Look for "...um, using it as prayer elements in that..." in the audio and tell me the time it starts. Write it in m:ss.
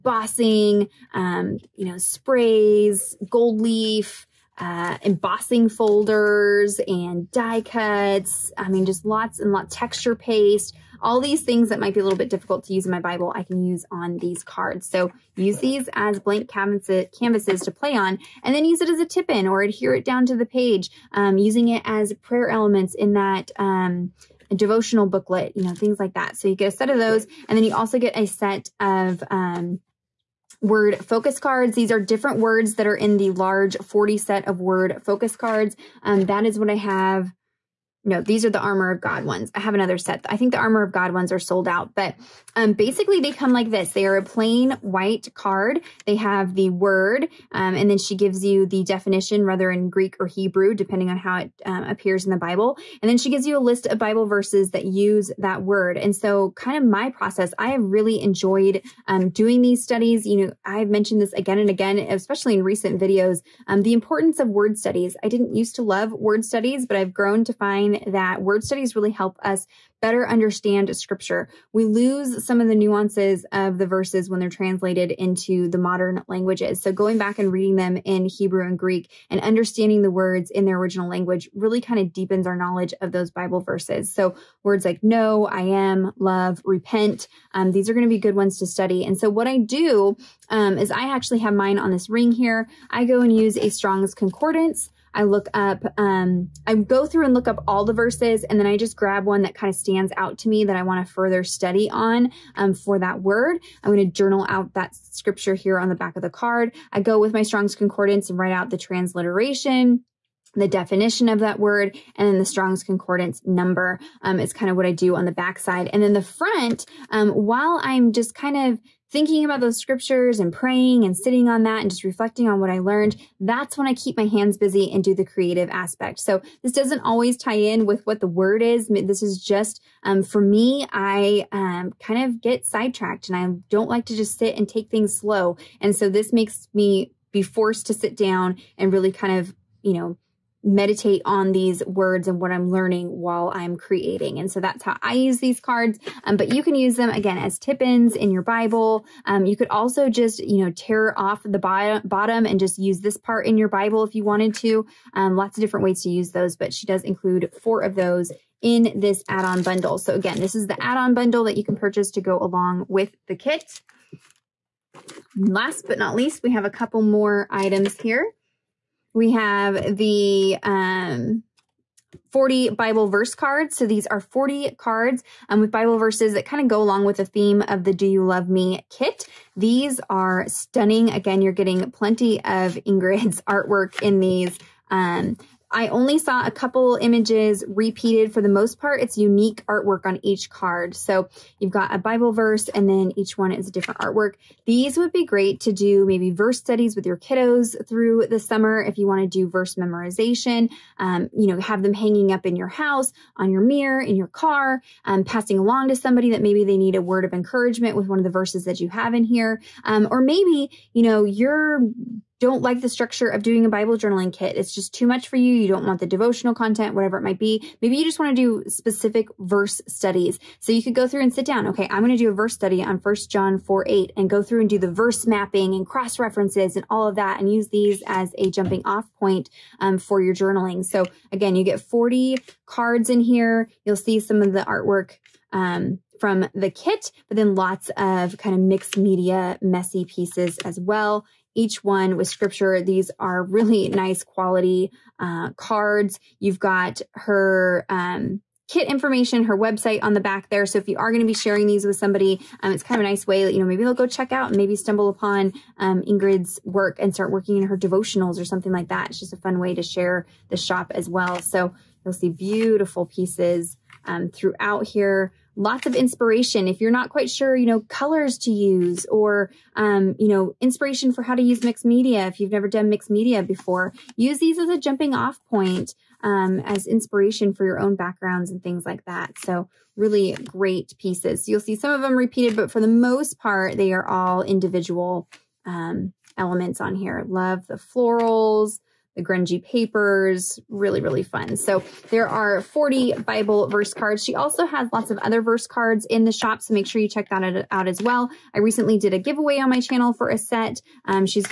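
0:21.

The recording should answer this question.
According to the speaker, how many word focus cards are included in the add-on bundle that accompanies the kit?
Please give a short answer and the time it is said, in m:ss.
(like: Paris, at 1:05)
4, at 2:37.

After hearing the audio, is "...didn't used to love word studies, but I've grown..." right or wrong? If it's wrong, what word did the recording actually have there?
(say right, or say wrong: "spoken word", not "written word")
right.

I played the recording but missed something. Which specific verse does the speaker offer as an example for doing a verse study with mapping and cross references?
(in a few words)
1 John 4:8.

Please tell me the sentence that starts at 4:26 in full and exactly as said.
If you're not quite sure, you know, colors to use or, um, you know, inspiration for how to use mixed media.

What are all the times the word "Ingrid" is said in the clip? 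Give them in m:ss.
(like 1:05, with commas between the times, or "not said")
3:02, 4:16.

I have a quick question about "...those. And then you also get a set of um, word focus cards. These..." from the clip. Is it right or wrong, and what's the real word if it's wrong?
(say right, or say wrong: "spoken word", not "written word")
right.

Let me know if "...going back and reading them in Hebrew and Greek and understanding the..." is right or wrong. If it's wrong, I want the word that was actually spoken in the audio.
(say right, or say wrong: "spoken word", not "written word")
right.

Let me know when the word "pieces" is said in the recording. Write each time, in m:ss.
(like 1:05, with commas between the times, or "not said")
4:00, 4:23, 4:40.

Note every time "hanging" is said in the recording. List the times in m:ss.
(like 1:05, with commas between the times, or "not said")
3:21.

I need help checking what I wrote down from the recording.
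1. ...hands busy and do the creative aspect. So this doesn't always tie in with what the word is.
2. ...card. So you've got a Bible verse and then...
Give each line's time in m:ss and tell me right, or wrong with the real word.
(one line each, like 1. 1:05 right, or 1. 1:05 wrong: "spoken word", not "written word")
1. 2:04 right
2. 3:10 right.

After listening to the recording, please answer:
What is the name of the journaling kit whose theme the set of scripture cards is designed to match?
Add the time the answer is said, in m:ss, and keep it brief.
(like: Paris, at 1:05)
Do You Love Me, at 2:57.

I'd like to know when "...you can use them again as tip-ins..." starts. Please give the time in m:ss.
2:26.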